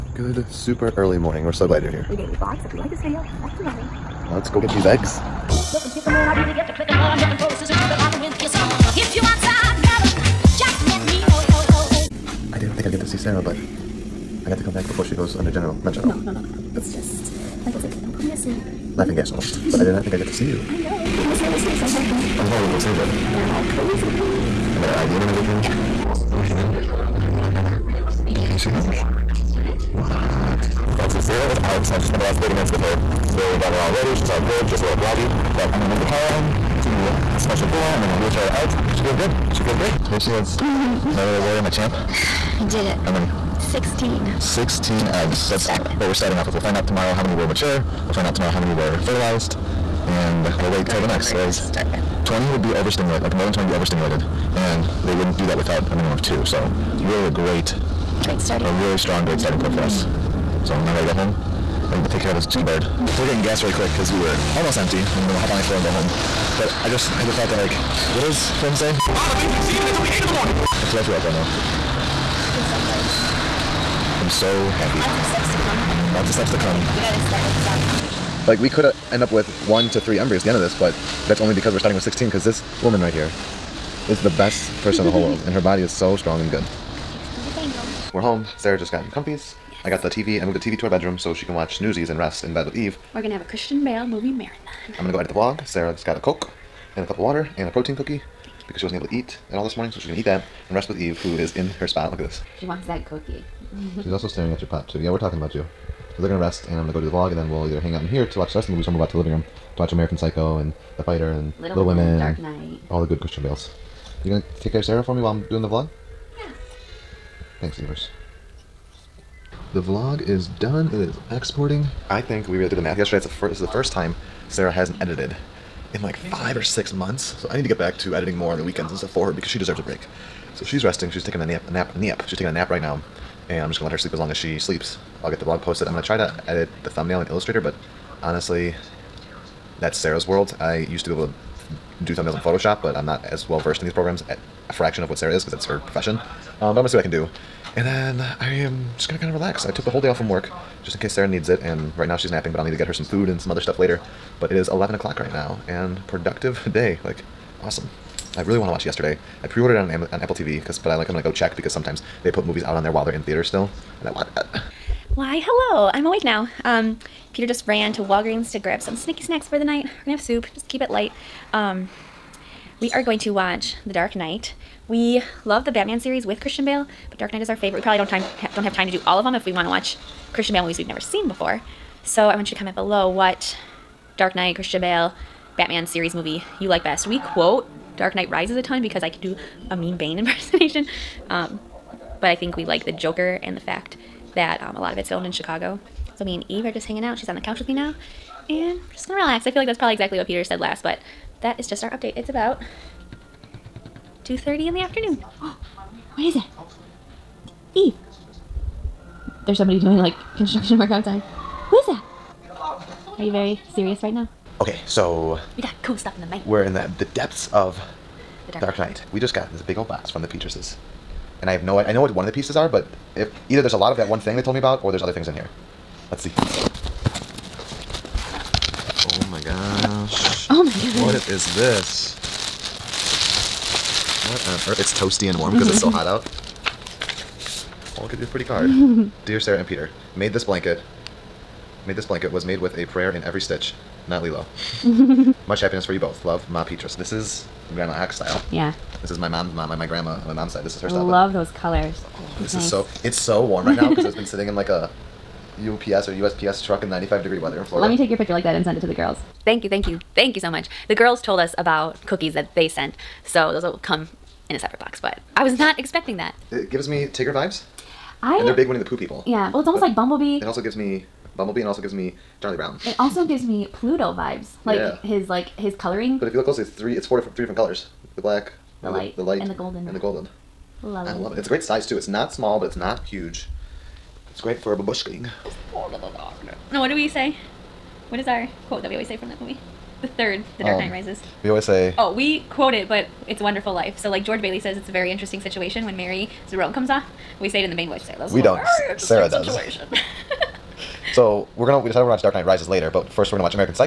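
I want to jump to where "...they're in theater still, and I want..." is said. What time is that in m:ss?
2:43.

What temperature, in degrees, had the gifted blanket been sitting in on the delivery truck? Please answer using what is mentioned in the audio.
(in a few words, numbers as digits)
95.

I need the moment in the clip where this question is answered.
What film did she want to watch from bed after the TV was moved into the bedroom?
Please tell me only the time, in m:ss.
1:31.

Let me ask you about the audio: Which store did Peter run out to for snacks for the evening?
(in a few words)
Walgreens.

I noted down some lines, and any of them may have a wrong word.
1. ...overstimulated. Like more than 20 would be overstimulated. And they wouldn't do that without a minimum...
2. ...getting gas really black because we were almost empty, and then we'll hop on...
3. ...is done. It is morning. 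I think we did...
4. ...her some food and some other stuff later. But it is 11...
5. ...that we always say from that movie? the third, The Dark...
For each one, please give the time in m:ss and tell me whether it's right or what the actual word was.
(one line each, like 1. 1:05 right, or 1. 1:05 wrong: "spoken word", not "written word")
1. 0:52 right
2. 1:03 wrong: "quick", not "black"
3. 2:00 wrong: "exporting", not "morning"
4. 2:32 right
5. 4:48 right.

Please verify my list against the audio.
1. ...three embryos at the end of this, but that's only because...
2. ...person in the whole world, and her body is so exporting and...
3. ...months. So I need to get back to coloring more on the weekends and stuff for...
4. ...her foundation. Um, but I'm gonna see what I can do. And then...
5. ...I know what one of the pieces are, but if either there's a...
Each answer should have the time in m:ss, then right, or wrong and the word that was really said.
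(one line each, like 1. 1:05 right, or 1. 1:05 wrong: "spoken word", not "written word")
1. 1:19 right
2. 1:24 wrong: "strong", not "exporting"
3. 2:06 wrong: "editing", not "coloring"
4. 2:25 wrong: "profession", not "foundation"
5. 3:41 right.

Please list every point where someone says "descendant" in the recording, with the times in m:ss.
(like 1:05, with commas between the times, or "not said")
not said.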